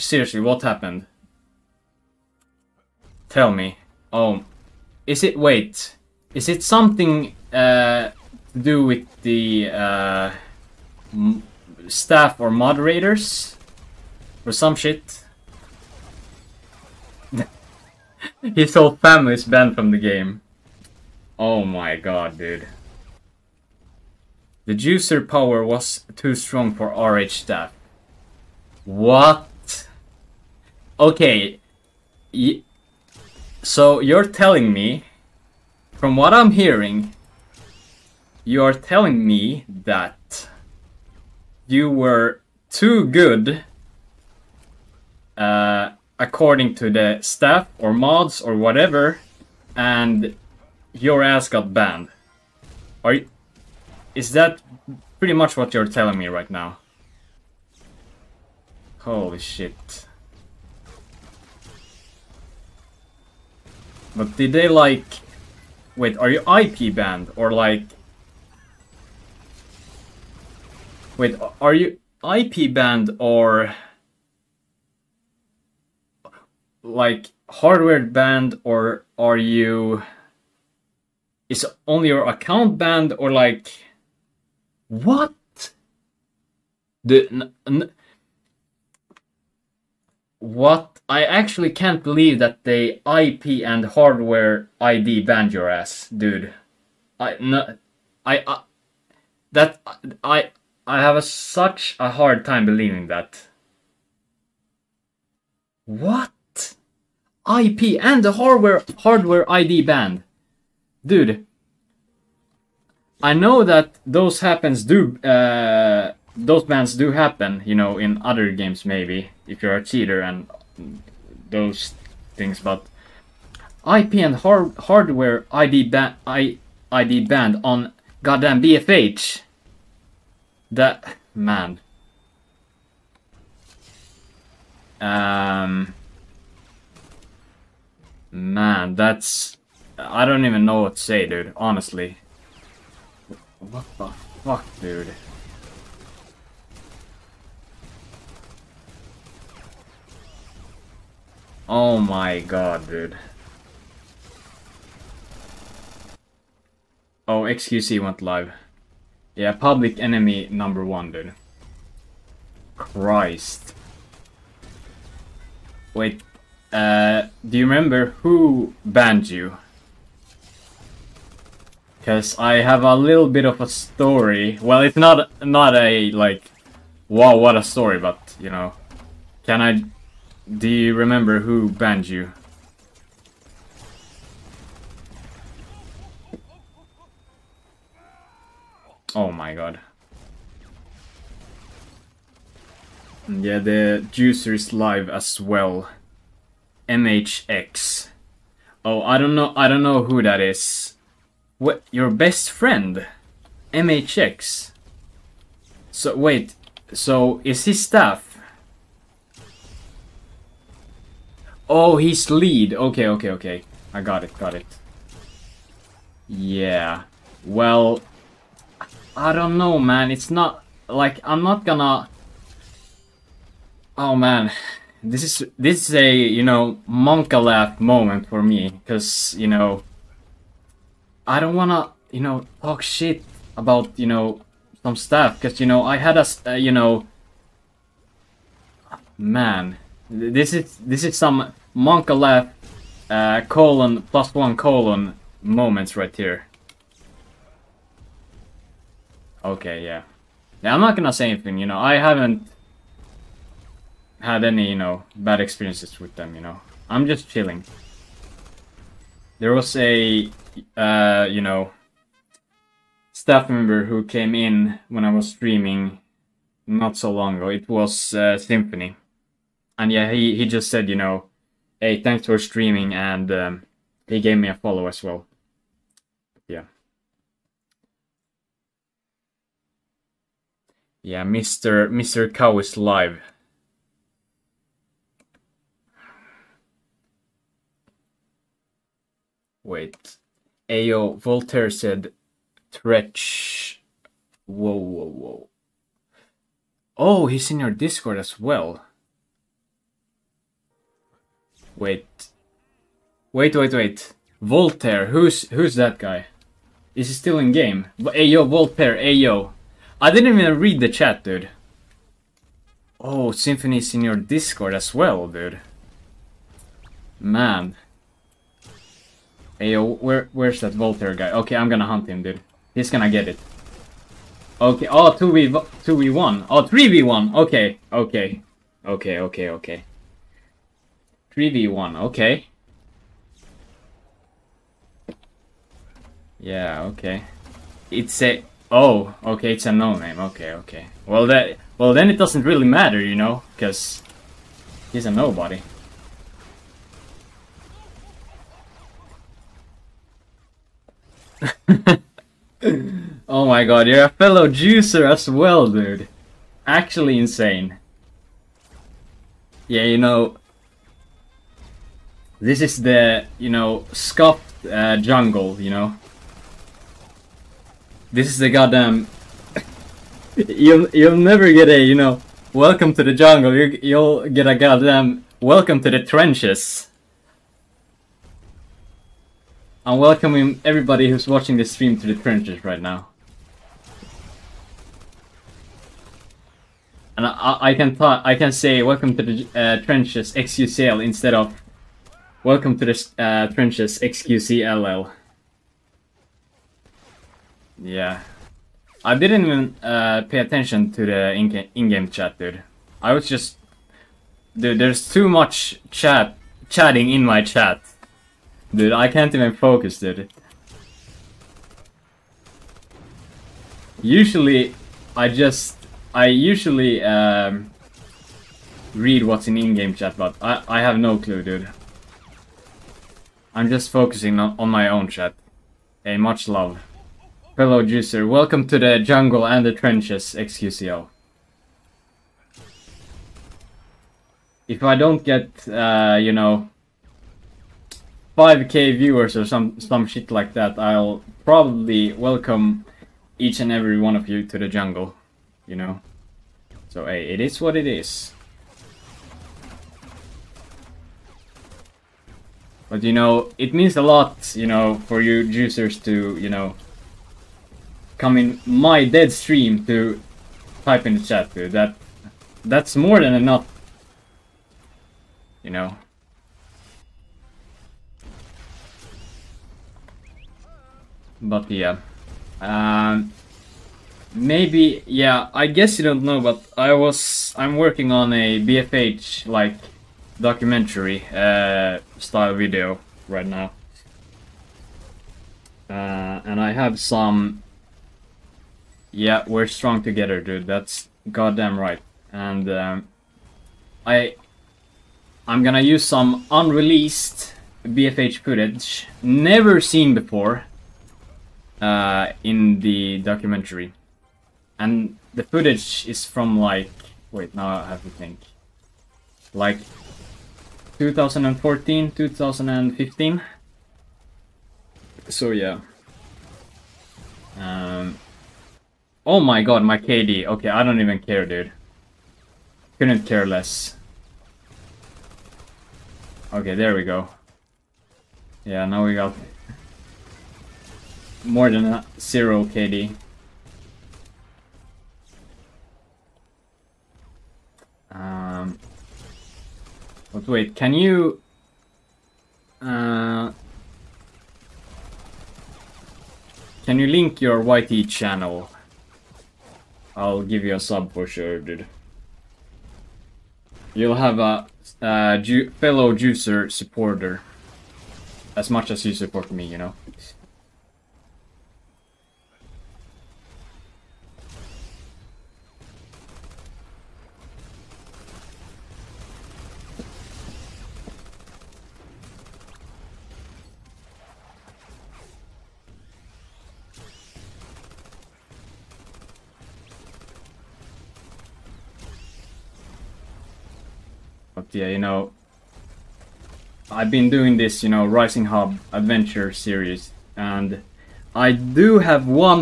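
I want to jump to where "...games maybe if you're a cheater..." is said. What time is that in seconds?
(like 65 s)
118 s.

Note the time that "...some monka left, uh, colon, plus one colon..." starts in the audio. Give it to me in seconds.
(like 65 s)
241 s.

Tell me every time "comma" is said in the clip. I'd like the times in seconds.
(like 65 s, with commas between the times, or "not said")
not said.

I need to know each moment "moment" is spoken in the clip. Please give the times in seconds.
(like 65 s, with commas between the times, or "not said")
227 s, 245 s.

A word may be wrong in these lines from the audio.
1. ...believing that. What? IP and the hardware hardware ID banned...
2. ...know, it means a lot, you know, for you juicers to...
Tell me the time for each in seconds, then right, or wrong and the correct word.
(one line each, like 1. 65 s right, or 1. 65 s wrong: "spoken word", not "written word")
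1. 102 s right
2. 453 s right.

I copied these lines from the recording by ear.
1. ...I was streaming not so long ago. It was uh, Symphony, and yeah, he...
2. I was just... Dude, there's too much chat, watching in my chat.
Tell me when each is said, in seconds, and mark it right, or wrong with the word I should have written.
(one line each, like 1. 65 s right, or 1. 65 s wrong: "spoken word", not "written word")
1. 265 s right
2. 403 s wrong: "chatting", not "watching".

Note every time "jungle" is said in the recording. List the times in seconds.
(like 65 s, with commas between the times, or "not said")
364 s, 373 s, 428 s, 444 s.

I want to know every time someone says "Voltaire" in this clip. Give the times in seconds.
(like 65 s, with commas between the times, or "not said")
291 s, 304 s, 308 s, 320 s.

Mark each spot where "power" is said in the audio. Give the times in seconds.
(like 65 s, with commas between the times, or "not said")
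25 s.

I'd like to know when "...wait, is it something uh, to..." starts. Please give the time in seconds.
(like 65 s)
5 s.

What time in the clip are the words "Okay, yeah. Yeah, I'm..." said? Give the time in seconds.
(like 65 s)
249 s.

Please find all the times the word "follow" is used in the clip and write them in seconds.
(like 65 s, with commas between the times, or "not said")
274 s.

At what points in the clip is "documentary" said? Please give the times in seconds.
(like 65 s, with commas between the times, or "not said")
480 s, 503 s.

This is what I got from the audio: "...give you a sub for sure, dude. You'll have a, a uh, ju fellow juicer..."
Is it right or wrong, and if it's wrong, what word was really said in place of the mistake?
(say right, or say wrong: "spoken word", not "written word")
right.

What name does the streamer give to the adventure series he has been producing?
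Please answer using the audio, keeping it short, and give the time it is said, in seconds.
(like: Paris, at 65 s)
Rising Hub, at 588 s.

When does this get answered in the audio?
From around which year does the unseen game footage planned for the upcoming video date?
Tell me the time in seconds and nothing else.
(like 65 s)
510 s.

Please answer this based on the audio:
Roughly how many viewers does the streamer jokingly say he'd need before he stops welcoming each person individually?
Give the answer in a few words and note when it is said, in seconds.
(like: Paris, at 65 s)
5k, at 438 s.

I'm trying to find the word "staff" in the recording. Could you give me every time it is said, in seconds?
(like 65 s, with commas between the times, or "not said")
11 s, 27 s, 47 s, 207 s, 263 s.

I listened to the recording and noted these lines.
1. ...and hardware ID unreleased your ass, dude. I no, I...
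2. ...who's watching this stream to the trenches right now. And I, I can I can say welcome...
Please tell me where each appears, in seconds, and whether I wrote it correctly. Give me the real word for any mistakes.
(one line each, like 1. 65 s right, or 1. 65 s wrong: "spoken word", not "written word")
1. 93 s wrong: "banned", not "unreleased"
2. 381 s right.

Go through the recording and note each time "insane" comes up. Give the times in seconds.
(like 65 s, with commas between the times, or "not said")
357 s.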